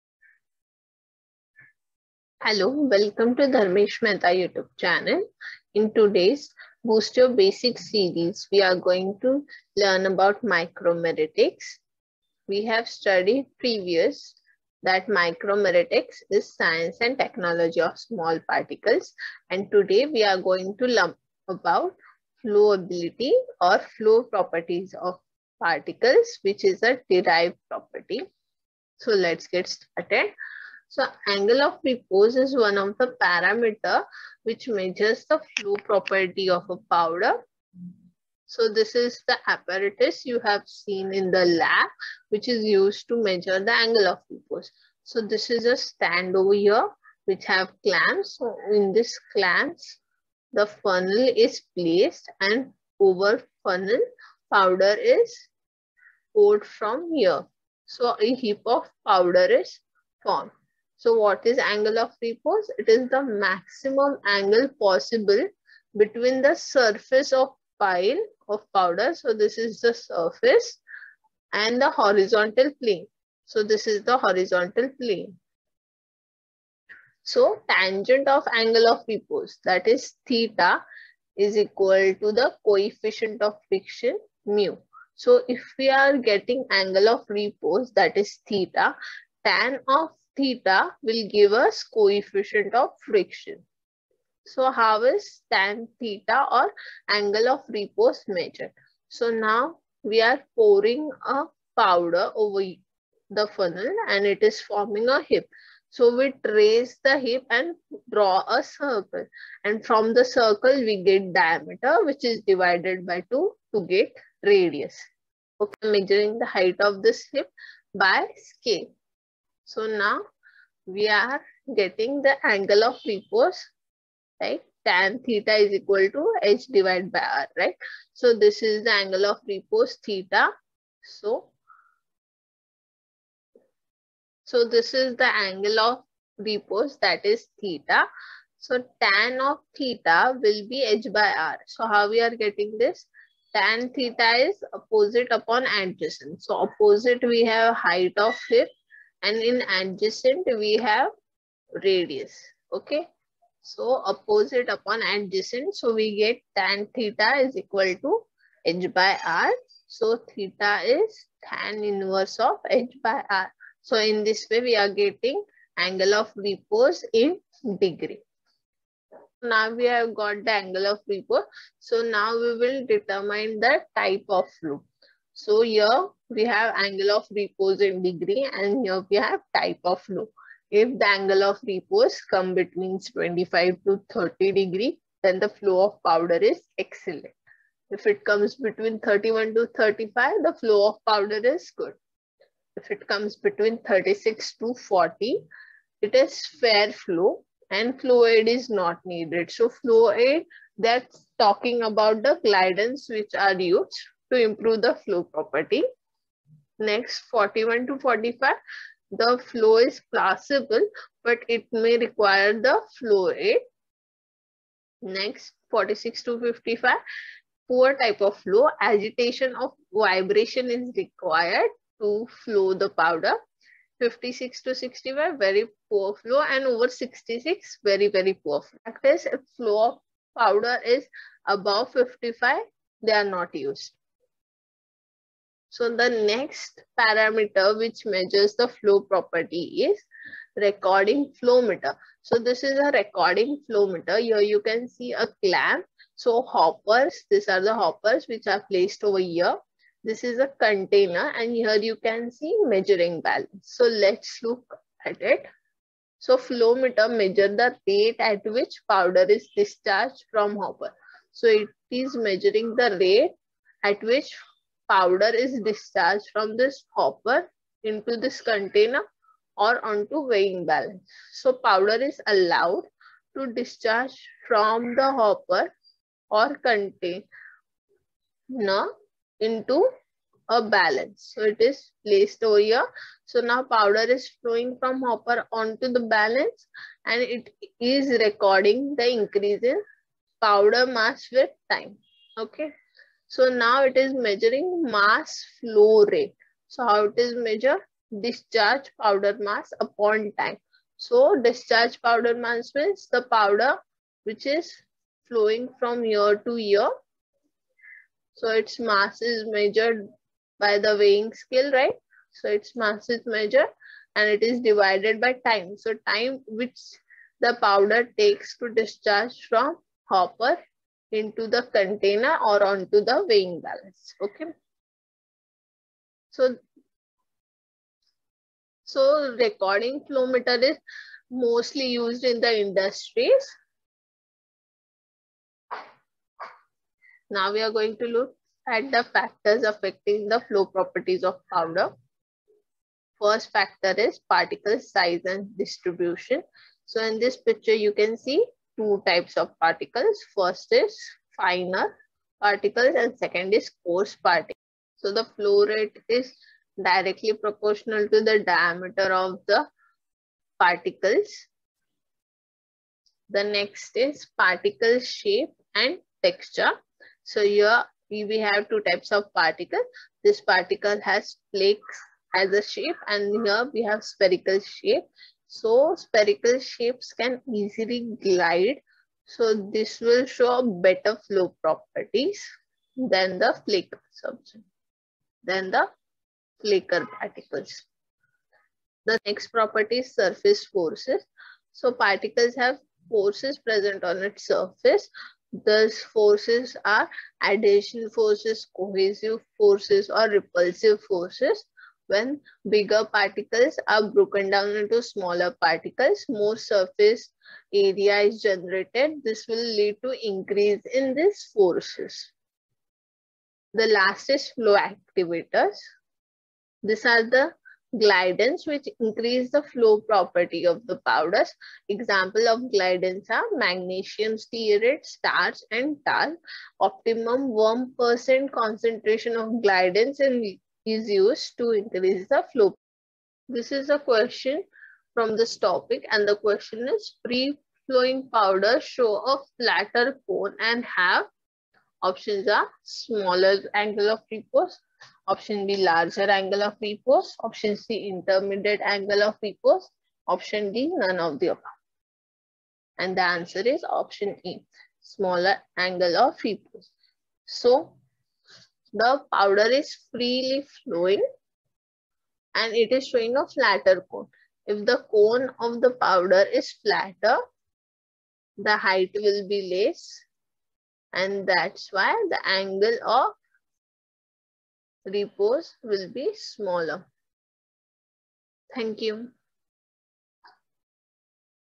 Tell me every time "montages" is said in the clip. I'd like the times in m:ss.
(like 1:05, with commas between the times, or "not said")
not said.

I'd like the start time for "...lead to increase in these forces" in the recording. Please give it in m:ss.
6:49.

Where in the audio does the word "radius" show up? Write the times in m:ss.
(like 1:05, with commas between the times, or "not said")
1:54, 2:31.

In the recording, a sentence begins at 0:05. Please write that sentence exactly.
In today's Boost Your Basic series, we are going to learn about micromeritics.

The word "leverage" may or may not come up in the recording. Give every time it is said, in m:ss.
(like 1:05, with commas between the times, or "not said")
not said.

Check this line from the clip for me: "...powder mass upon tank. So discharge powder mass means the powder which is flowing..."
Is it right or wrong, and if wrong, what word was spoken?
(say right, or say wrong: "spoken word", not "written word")
right.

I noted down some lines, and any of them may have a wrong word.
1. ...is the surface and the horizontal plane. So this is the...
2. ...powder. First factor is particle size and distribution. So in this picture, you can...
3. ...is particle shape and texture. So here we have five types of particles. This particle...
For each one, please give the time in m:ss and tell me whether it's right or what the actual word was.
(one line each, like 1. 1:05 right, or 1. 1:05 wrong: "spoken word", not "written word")
1. 1:09 right
2. 5:41 right
3. 6:03 wrong: "two", not "five".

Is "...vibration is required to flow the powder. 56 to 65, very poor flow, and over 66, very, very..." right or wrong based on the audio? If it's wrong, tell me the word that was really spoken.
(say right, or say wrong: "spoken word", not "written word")
right.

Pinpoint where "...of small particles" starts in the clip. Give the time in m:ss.
0:17.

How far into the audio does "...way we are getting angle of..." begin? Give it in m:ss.
2:44.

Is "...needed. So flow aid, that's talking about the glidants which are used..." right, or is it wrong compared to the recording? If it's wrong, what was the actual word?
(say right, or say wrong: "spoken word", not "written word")
right.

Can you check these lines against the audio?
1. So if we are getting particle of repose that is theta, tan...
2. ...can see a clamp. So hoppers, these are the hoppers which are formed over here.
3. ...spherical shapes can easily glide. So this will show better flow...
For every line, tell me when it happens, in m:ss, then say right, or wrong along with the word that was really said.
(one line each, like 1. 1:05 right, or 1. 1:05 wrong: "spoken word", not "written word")
1. 1:25 wrong: "angle", not "particle"
2. 4:04 wrong: "placed", not "formed"
3. 6:15 right.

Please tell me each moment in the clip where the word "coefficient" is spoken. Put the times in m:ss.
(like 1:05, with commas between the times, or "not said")
1:22, 1:31.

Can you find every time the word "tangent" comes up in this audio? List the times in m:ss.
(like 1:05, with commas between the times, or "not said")
1:17.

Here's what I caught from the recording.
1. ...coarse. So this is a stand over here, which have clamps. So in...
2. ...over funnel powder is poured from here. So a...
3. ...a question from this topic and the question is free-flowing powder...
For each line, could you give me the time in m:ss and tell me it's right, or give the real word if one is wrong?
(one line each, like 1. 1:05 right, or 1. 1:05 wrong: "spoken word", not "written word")
1. 0:44 wrong: "repose", not "coarse"
2. 0:52 right
3. 7:13 right.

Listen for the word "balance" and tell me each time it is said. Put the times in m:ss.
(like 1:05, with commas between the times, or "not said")
4:13, 4:30, 4:40, 4:46, 5:23.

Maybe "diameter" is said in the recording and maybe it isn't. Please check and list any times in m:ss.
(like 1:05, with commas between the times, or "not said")
1:51, 5:58.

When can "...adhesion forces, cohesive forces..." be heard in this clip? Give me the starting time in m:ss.
6:37.